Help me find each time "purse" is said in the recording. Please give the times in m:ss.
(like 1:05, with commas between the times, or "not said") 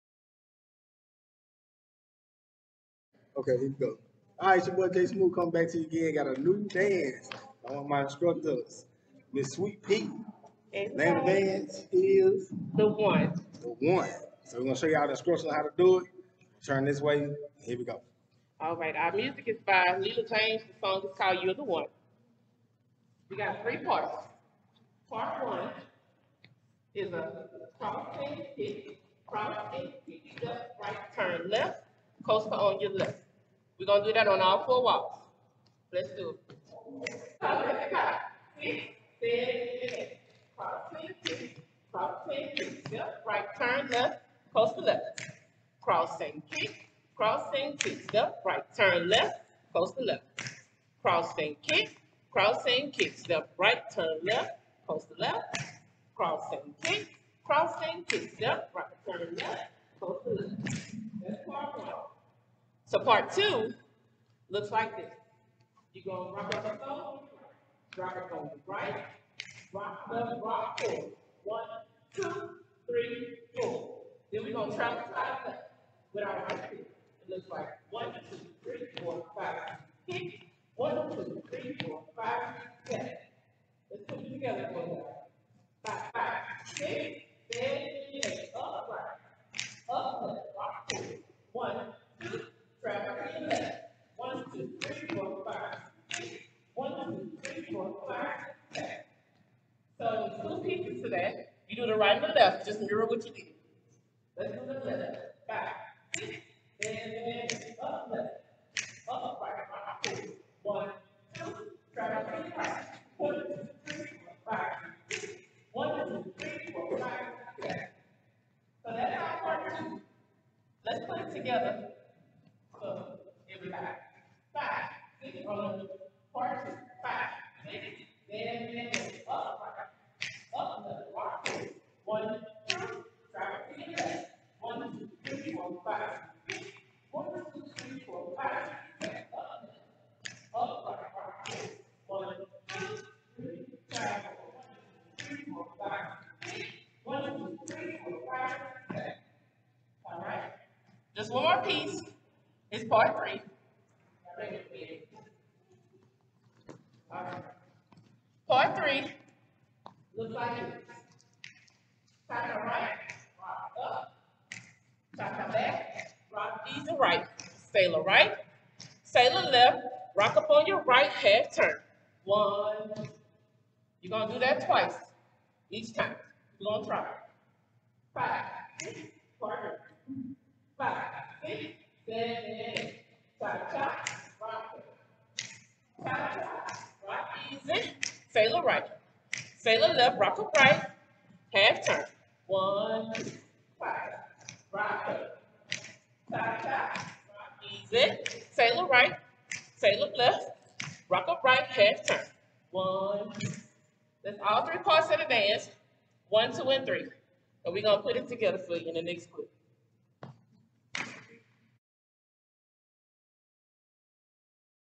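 not said.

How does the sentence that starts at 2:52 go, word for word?
One, you're gonna do that twice each time.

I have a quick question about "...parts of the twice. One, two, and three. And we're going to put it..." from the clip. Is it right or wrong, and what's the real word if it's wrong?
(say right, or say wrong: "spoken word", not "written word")
wrong: "dance", not "twice".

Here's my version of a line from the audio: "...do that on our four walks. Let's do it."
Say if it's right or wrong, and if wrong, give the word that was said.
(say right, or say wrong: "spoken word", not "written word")
right.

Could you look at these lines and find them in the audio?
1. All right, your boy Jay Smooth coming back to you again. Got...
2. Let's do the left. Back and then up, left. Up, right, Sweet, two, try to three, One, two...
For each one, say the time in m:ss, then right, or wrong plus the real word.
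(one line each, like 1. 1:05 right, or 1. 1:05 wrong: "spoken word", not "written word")
1. 0:04 right
2. 1:44 wrong: "One", not "Sweet".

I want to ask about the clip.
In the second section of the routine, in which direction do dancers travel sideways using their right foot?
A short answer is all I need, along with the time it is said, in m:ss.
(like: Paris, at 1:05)
side left, at 1:15.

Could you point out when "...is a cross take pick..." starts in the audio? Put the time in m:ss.
0:26.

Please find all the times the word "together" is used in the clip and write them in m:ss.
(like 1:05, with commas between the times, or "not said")
2:01, 3:28.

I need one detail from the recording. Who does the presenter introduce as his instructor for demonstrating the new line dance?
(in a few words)
Miss Sweet P.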